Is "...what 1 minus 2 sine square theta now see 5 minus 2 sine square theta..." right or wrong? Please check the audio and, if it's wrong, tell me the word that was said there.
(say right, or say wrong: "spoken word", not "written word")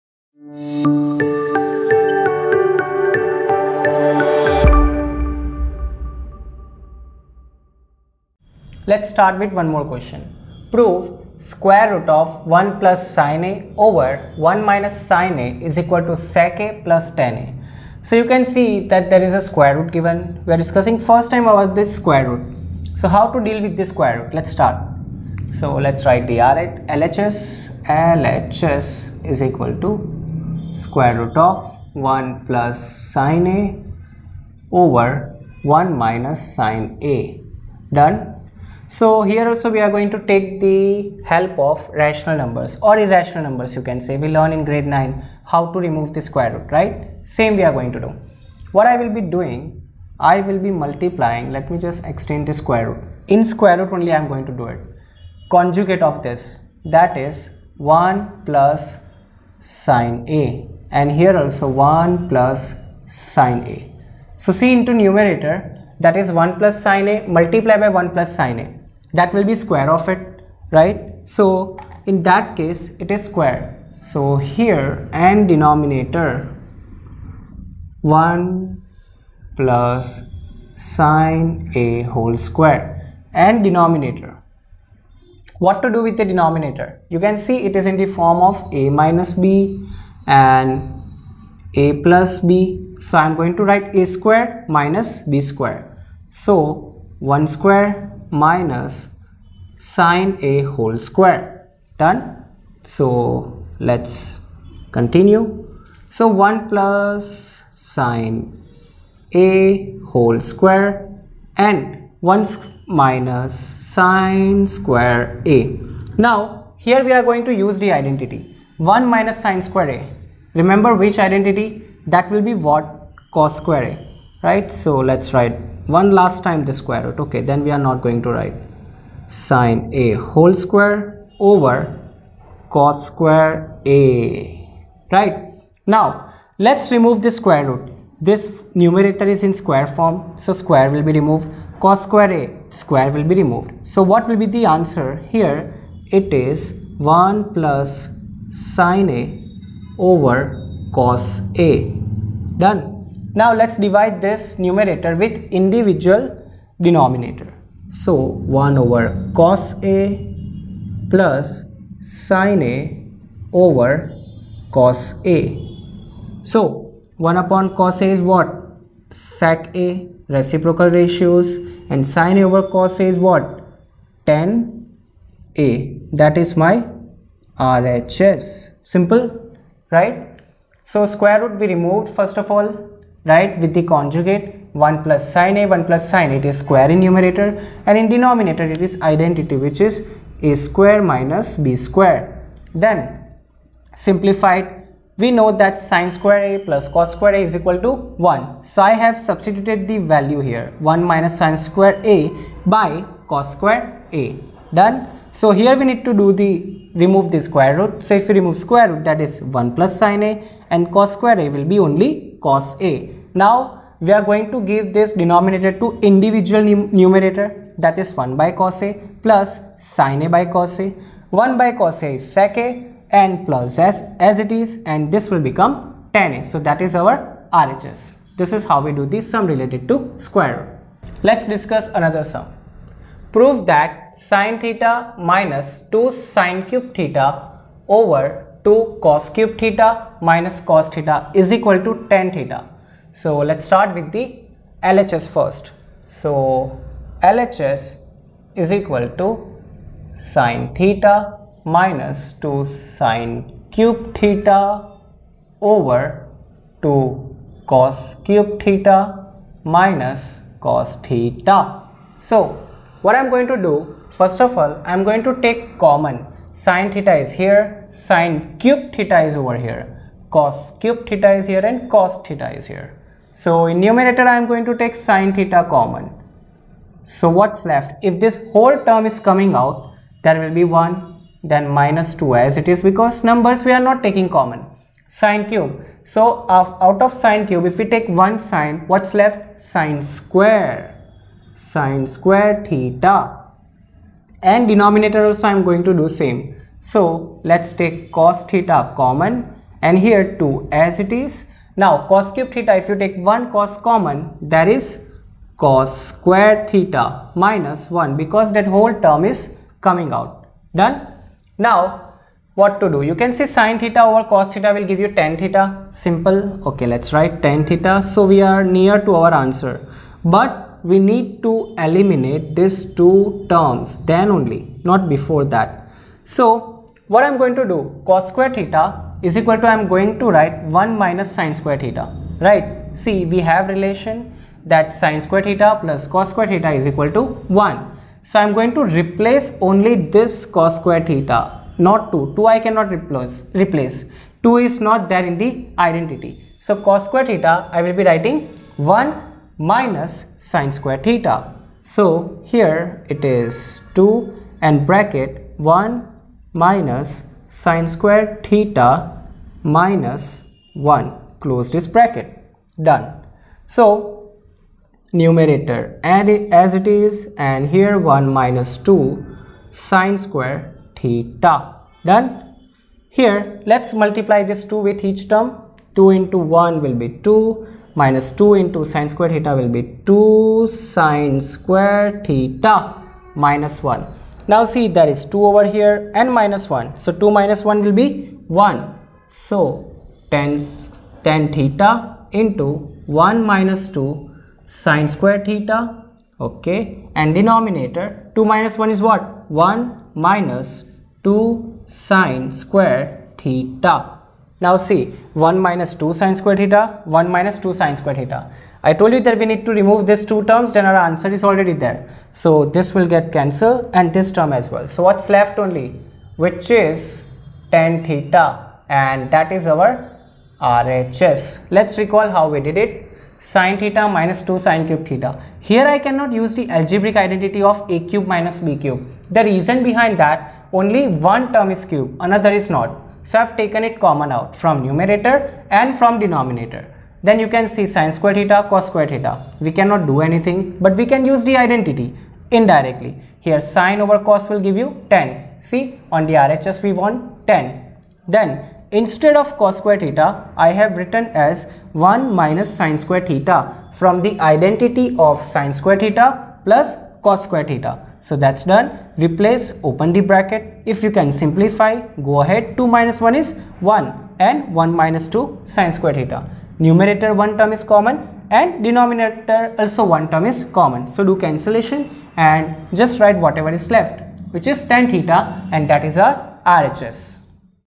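wrong: "1", not "5".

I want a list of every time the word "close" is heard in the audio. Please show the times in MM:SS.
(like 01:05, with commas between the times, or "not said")
06:01.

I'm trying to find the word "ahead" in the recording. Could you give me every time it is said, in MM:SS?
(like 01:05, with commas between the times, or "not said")
07:42.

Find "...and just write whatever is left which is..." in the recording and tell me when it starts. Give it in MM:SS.
07:52.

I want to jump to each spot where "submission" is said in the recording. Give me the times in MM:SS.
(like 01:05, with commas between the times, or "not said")
not said.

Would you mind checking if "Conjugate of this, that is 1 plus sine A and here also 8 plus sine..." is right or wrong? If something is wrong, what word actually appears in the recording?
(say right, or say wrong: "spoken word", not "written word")
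wrong: "1", not "8".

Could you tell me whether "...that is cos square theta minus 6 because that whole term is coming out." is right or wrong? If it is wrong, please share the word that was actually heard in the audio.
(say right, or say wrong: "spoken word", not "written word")
wrong: "1", not "6".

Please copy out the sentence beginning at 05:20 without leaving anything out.
But we need to eliminate these two terms then only, not before that.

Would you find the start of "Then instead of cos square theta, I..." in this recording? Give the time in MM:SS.
07:28.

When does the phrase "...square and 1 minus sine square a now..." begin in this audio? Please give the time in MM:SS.
01:50.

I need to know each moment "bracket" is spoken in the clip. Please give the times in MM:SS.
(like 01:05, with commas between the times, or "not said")
05:54, 06:01, 07:40.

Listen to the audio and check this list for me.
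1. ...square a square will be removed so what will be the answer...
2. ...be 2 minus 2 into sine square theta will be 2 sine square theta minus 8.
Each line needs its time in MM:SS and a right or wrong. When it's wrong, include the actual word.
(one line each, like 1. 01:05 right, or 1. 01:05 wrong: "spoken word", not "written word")
1. 02:22 right
2. 06:17 wrong: "1", not "8".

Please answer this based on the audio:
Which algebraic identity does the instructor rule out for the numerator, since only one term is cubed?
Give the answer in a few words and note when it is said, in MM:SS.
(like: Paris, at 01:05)
a cube minus b cube, at 07:07.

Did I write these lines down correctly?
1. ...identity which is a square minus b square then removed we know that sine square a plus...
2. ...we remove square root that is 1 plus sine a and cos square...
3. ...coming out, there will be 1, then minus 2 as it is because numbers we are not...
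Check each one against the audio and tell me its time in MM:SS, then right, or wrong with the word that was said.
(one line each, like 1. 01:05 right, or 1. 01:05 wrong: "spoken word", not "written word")
1. 03:09 wrong: "simplified", not "removed"
2. 03:28 right
3. 04:39 right.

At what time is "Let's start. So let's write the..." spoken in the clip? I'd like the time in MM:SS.
00:24.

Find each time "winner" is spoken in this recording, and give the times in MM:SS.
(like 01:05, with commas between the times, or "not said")
not said.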